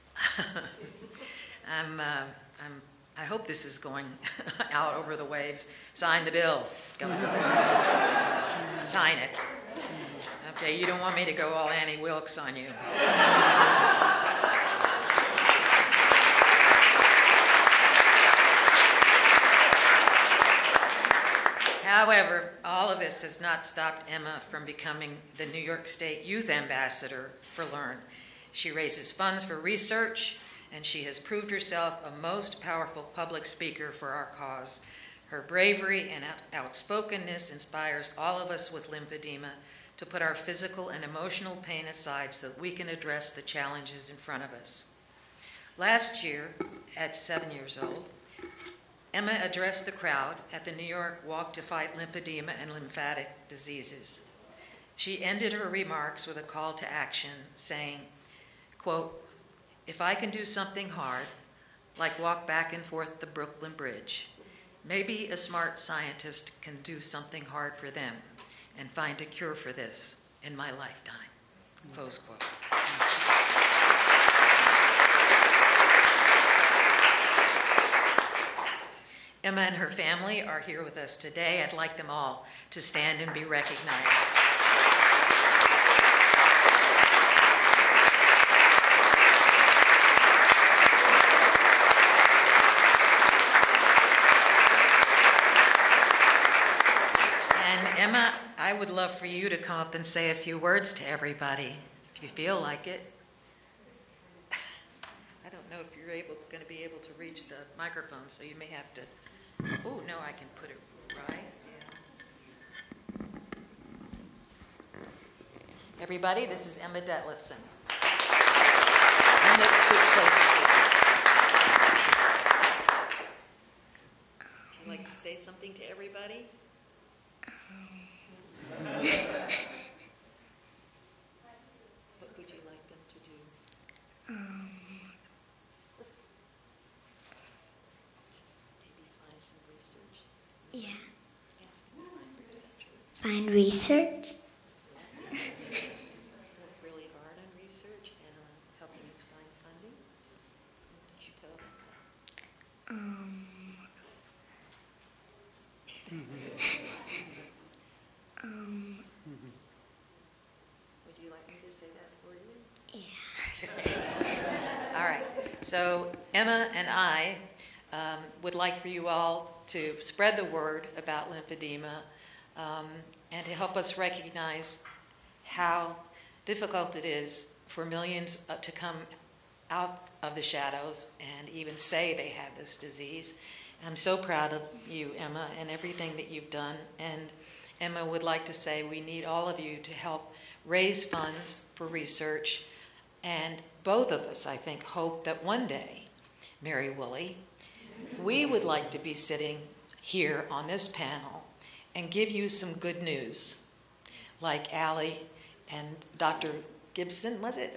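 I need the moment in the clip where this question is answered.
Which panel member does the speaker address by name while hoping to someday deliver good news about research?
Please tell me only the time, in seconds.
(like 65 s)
196 s.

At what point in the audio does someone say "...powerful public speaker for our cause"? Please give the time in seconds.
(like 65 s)
32 s.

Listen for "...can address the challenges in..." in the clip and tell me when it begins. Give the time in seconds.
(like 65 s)
42 s.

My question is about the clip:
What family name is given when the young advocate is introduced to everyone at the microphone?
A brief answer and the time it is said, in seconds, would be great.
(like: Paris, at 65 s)
Detlefson, at 117 s.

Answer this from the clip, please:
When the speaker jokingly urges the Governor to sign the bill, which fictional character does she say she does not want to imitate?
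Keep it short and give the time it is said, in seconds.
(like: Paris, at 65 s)
Annie Wilkes, at 11 s.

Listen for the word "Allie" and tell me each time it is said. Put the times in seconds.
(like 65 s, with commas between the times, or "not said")
204 s.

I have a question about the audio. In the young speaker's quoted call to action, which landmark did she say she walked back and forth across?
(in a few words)
Brooklyn Bridge.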